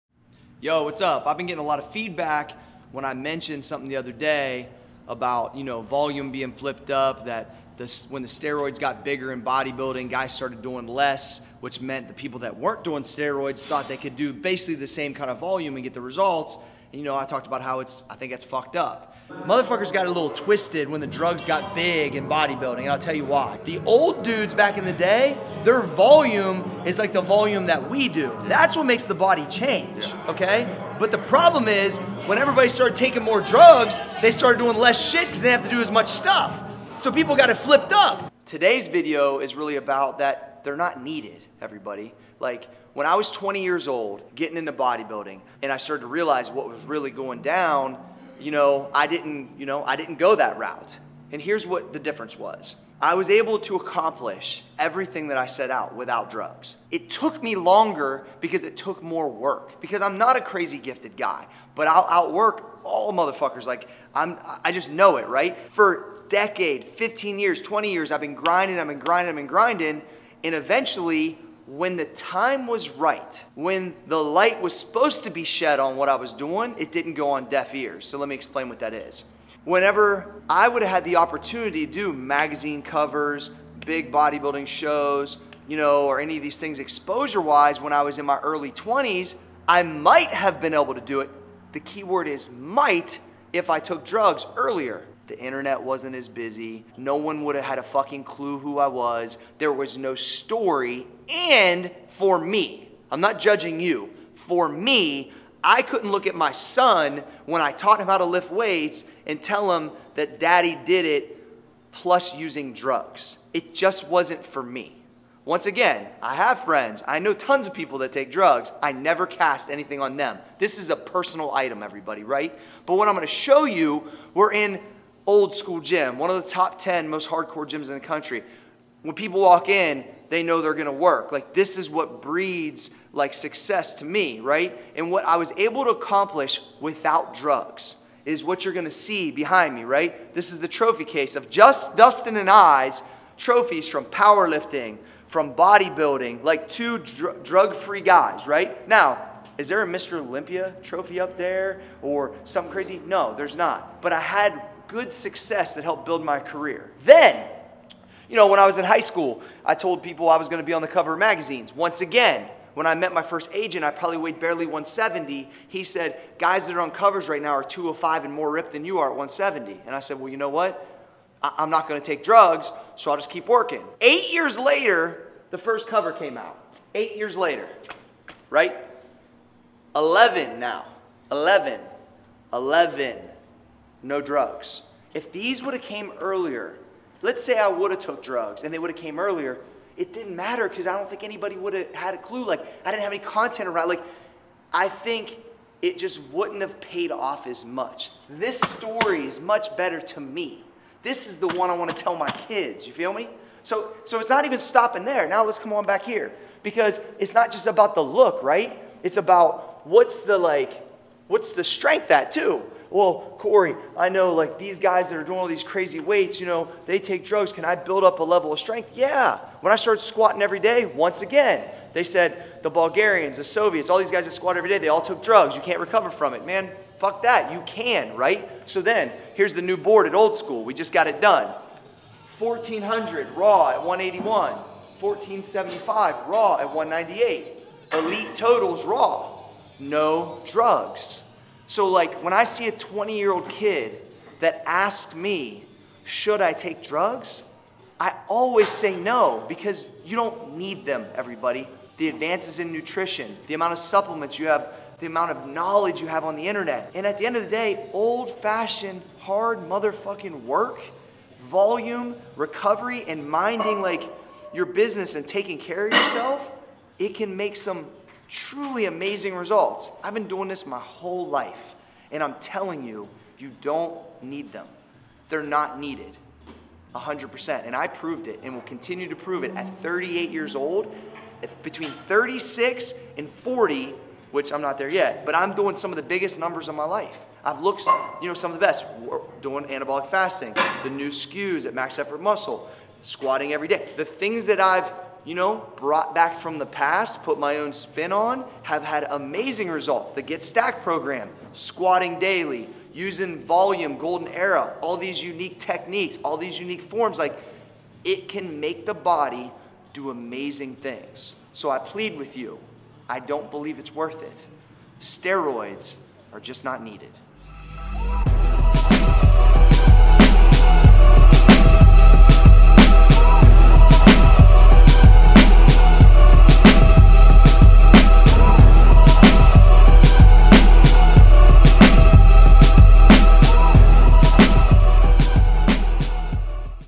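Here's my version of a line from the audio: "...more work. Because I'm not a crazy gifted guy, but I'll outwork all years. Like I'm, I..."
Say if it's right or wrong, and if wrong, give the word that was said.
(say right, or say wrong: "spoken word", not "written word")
wrong: "motherfuckers", not "years".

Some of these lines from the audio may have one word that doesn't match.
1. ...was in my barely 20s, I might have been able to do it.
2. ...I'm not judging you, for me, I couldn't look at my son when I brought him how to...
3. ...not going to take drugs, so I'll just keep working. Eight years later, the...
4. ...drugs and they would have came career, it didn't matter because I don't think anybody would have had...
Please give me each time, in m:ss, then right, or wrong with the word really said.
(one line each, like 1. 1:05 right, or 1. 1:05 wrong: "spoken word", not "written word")
1. 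1:28 wrong: "early", not "barely"
2. 1:43 wrong: "taught", not "brought"
3. 2:51 right
4. 3:08 wrong: "earlier", not "career".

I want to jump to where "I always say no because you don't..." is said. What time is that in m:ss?
4:07.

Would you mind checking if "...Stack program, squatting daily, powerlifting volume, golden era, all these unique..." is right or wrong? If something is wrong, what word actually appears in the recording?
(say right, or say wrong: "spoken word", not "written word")
wrong: "using", not "powerlifting".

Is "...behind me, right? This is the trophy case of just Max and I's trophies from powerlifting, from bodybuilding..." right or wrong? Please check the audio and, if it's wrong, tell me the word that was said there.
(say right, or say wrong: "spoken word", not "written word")
wrong: "Dustin", not "Max".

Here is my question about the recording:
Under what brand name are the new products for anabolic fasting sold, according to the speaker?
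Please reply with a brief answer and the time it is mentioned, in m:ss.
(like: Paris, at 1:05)
Max Effort Muscle, at 4:51.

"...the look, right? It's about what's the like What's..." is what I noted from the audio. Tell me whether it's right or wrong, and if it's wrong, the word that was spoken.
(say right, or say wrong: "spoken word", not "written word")
right.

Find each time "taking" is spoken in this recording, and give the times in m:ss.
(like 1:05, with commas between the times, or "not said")
0:32, 4:25.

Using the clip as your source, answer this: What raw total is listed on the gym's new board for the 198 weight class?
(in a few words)
1475.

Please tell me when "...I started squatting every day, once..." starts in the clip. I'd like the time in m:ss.
3:39.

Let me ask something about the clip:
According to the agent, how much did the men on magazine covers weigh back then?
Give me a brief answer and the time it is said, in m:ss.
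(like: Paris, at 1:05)
205, at 2:47.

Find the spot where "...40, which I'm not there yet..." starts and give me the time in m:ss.
4:43.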